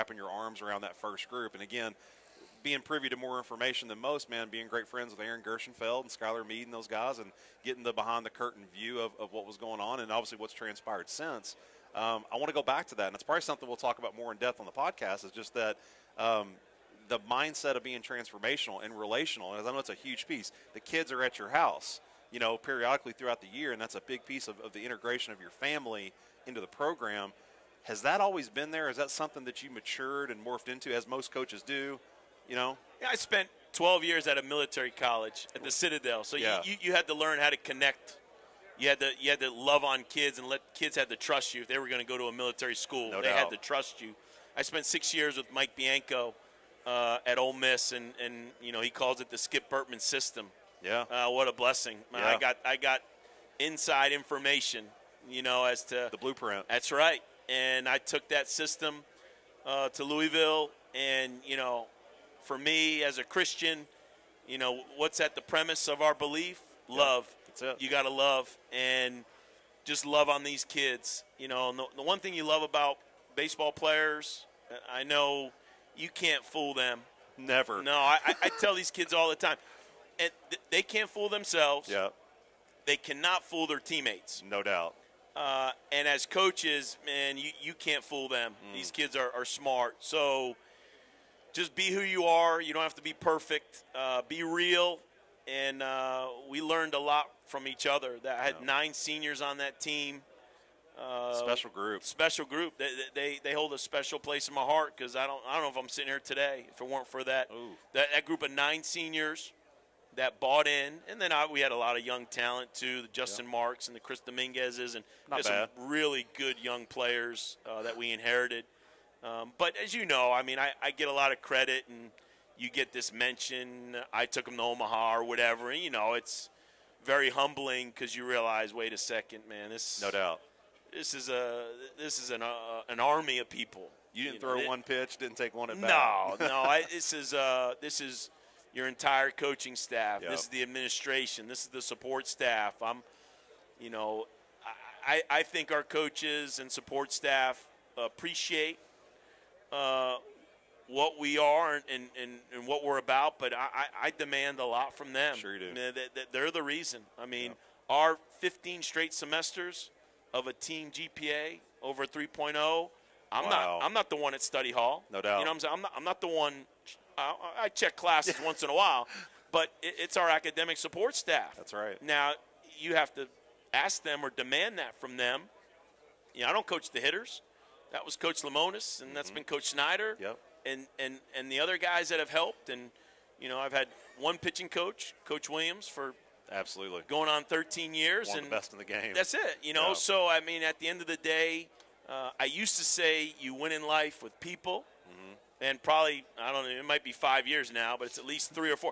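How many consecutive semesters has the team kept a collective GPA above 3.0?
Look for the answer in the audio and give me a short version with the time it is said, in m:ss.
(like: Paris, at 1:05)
15, at 2:38.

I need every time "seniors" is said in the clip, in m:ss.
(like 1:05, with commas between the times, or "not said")
1:38, 1:48.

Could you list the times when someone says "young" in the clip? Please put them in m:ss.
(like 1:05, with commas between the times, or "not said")
1:52, 1:56.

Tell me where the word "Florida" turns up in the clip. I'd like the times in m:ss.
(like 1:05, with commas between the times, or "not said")
not said.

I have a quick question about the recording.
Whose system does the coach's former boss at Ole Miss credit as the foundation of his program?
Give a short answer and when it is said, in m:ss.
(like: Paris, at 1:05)
Skip Bertman, at 0:49.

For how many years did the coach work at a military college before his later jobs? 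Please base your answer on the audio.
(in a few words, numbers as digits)
12.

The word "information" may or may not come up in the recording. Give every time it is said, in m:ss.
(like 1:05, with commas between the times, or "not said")
0:03, 0:54.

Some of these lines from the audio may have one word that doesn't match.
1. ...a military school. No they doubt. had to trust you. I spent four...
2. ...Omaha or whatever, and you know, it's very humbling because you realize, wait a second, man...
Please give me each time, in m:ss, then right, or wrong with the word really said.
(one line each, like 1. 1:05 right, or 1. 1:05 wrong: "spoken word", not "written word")
1. 0:42 wrong: "six", not "four"
2. 2:04 right.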